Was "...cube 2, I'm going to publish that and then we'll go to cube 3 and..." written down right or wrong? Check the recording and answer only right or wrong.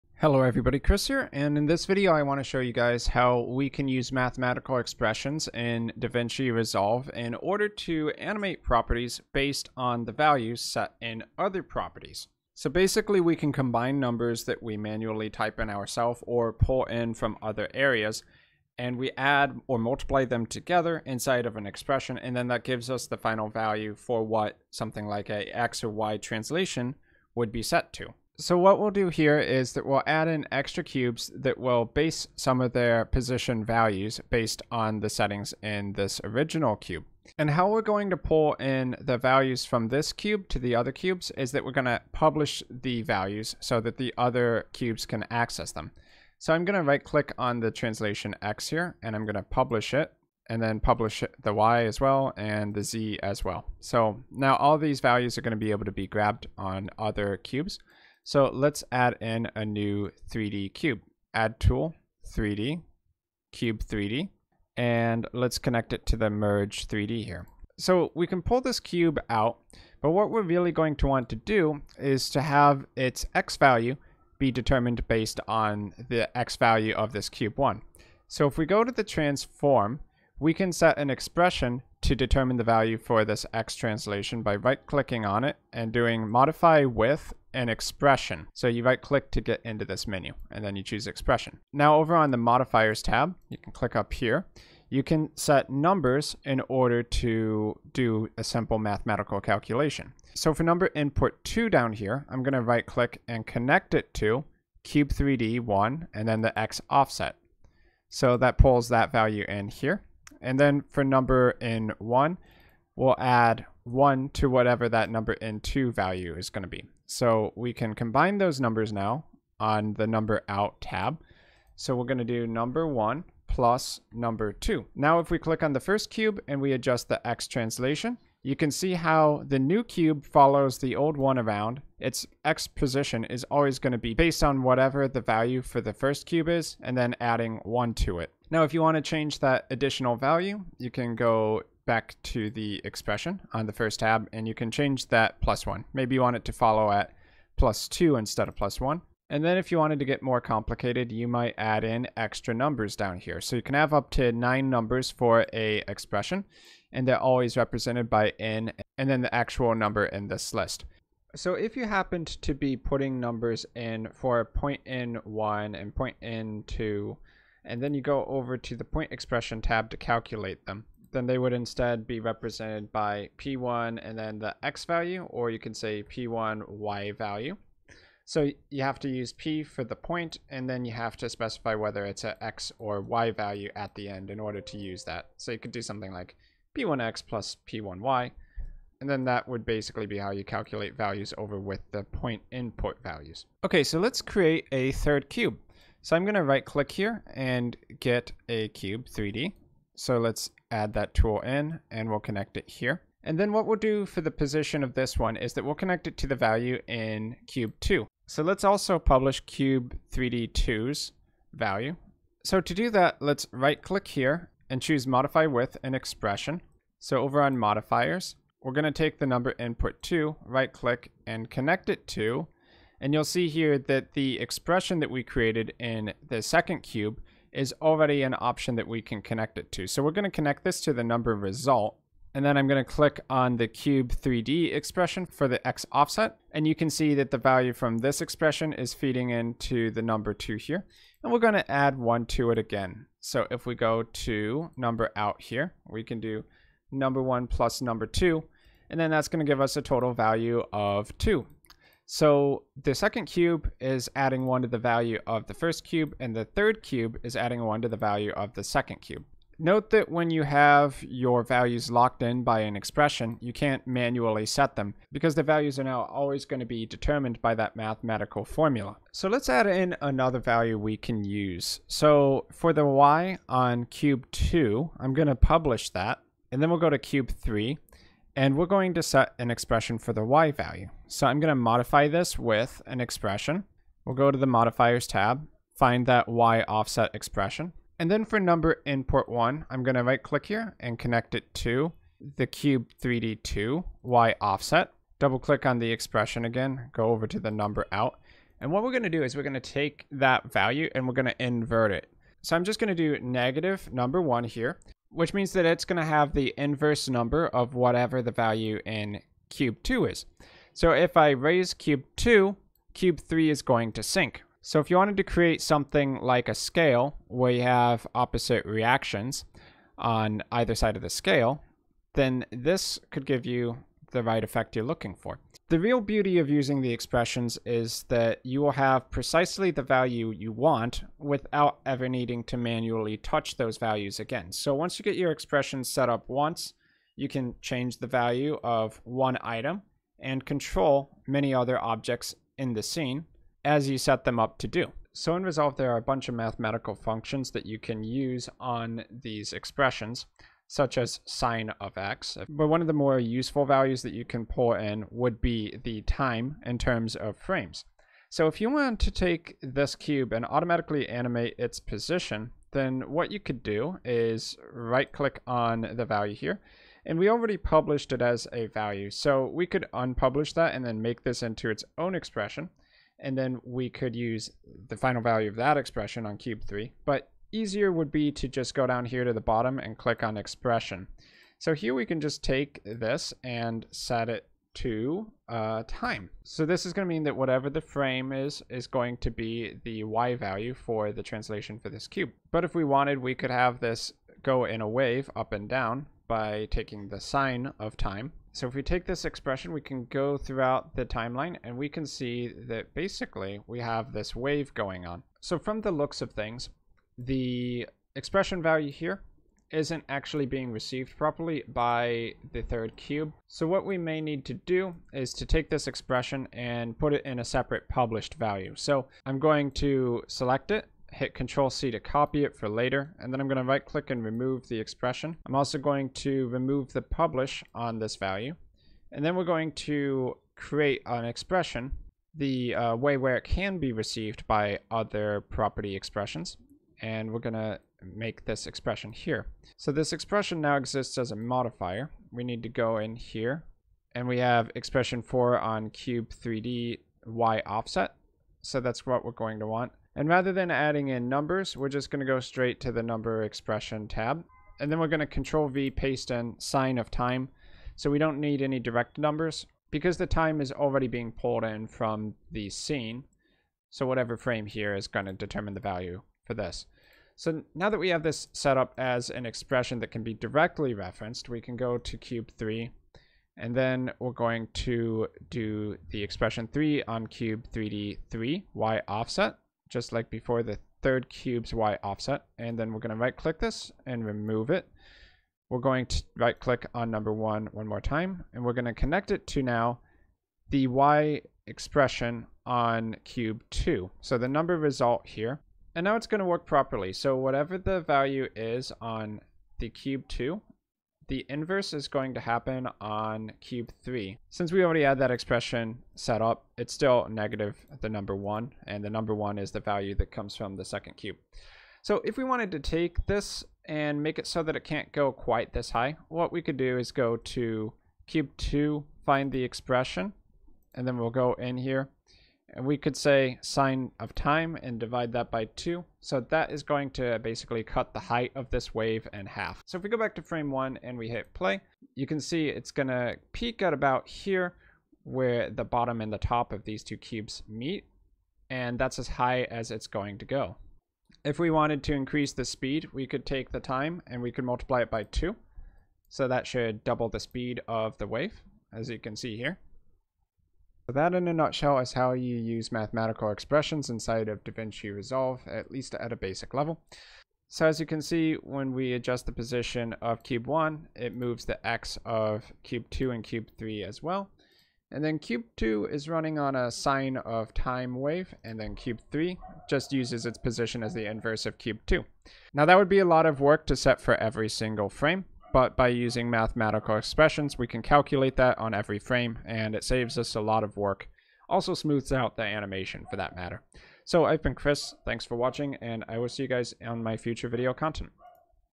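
right.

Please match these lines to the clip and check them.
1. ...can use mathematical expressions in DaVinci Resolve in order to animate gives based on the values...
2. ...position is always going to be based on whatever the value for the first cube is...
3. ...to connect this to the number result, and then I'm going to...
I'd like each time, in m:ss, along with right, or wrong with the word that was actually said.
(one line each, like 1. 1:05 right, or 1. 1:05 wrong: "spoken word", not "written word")
1. 0:03 wrong: "properties", not "gives"
2. 2:12 right
3. 3:50 right.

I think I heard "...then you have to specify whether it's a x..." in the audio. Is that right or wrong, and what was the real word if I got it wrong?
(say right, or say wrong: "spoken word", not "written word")
right.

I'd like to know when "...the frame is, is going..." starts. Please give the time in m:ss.
6:27.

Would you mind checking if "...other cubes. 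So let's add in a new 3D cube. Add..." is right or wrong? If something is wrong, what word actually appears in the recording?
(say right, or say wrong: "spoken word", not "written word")
right.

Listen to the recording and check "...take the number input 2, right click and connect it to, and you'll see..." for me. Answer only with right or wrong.
right.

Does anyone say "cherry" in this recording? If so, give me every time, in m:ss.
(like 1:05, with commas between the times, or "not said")
not said.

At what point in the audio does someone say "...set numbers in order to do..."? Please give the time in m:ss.
1:35.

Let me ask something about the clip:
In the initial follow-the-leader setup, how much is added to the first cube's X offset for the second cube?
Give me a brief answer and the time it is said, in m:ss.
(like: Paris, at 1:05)
1, at 1:53.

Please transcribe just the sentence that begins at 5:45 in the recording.
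So in Resolve, there are a bunch of mathematical functions that you can use on these expressions, such as sine of x.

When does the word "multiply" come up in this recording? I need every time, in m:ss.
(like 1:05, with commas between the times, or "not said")
0:19, 9:04.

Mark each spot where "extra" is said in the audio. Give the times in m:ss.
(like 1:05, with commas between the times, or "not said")
0:30, 2:32.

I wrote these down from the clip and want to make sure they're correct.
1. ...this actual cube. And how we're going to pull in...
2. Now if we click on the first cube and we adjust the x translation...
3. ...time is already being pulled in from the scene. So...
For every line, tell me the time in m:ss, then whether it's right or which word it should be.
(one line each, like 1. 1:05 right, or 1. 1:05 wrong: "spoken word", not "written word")
1. 0:35 wrong: "original", not "actual"
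2. 2:04 right
3. 7:40 right.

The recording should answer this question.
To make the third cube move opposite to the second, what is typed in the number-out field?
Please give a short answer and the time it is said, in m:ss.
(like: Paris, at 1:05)
negative number one, at 5:03.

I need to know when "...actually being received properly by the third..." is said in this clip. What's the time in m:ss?
6:50.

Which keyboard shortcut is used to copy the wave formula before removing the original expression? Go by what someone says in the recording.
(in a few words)
Control C.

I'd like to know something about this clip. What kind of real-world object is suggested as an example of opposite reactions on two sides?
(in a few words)
A scale.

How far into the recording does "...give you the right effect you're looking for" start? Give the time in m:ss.
5:23.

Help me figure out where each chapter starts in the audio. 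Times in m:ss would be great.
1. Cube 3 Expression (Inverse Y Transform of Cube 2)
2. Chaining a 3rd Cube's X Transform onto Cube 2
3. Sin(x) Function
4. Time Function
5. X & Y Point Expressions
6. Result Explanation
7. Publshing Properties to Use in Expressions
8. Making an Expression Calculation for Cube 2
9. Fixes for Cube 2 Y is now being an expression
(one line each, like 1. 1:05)
1. 4:28
2. 3:13
3. 6:31
4. 5:44
5. 2:40
6. 9:10
7. 0:37
8. 0:58
9. 6:44.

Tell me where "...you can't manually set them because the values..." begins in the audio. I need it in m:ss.
4:23.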